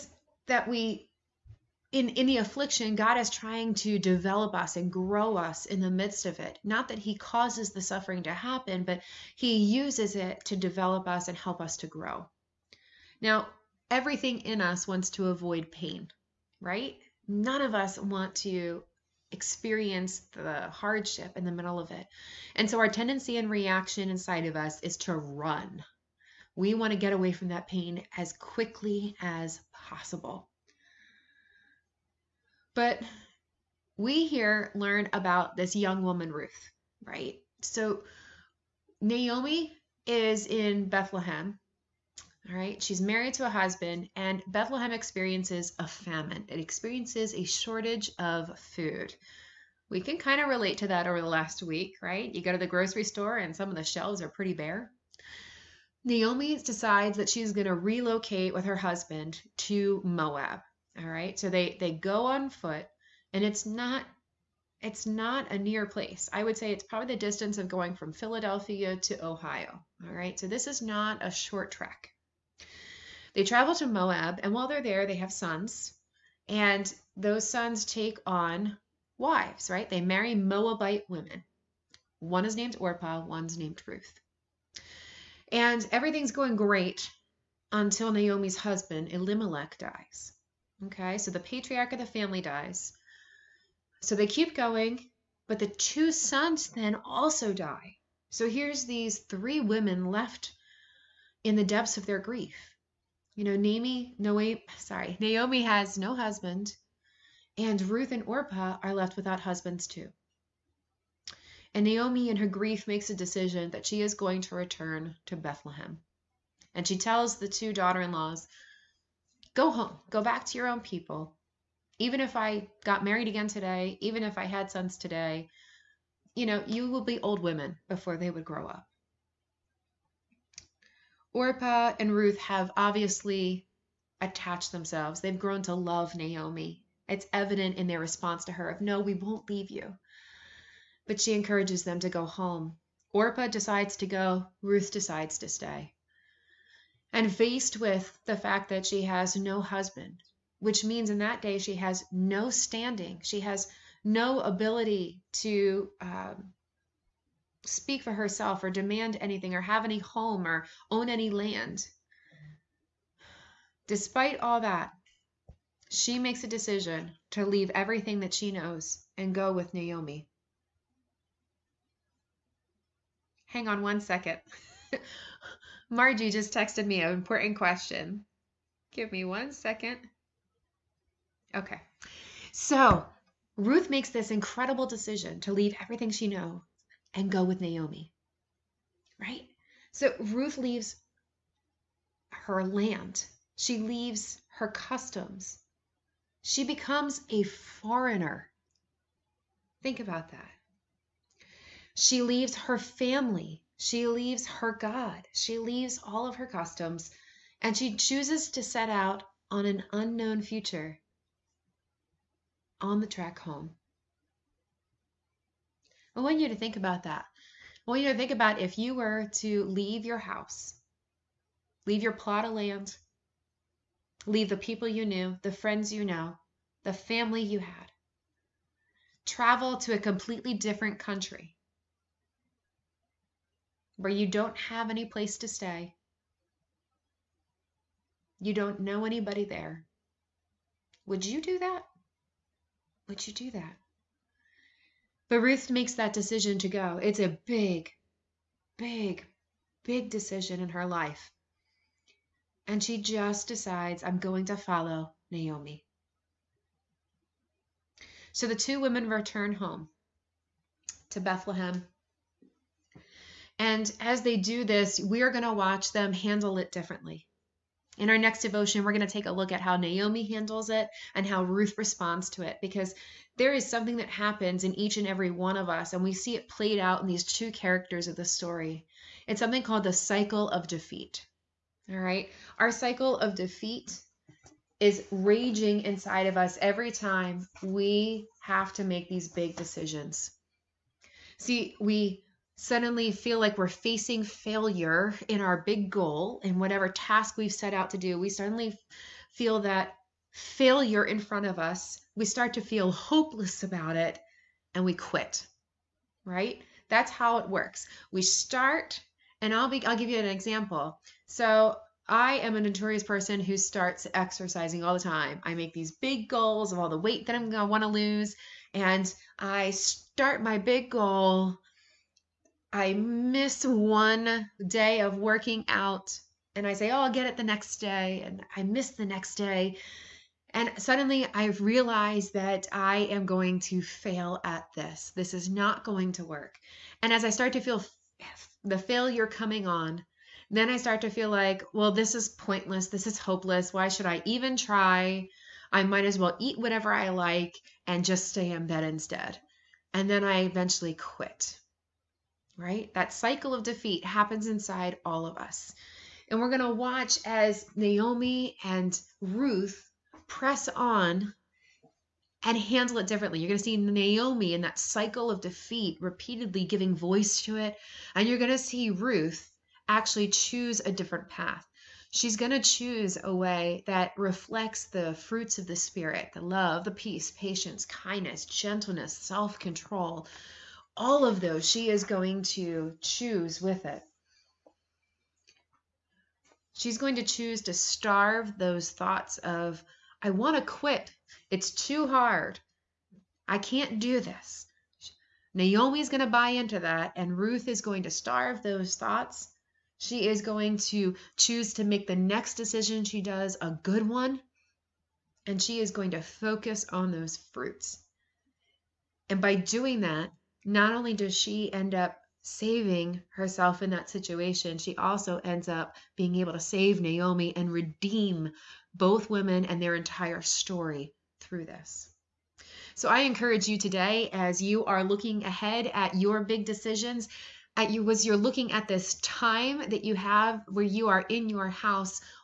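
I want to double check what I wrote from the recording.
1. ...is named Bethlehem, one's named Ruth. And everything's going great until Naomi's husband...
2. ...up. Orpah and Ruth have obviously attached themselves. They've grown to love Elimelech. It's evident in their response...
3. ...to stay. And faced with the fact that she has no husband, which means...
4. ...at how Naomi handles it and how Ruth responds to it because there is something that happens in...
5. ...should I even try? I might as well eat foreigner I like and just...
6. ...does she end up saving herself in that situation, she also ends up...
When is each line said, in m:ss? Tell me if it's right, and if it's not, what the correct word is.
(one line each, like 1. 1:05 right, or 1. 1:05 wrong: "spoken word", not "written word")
1. 1:22 wrong: "Orpah", not "Bethlehem"
2. 2:08 wrong: "Naomi", not "Elimelech"
3. 2:25 right
4. 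4:29 right
5. 5:43 wrong: "whatever", not "foreigner"
6. 6:51 right.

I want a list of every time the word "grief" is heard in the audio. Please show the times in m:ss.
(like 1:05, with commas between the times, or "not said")
1:42, 1:52.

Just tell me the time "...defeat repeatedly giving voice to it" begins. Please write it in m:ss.
6:05.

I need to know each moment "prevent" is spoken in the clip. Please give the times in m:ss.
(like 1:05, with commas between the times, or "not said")
not said.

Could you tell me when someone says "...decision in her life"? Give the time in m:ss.
4:10.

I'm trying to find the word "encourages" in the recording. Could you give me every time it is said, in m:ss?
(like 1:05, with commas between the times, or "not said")
2:21, 7:03.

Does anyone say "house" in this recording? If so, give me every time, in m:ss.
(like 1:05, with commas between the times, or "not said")
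3:40, 7:11.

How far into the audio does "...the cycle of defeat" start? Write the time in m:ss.
4:39.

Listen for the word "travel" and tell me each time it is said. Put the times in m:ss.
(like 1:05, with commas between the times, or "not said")
1:13, 3:49.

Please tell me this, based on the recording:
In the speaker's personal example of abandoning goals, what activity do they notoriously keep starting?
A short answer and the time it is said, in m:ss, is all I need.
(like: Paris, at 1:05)
exercising, at 5:14.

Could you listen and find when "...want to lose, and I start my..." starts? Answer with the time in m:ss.
5:17.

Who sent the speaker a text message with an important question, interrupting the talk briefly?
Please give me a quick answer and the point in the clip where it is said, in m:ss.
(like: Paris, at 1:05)
Margie, at 2:55.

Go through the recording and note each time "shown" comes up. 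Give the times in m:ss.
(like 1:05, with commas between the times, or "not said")
not said.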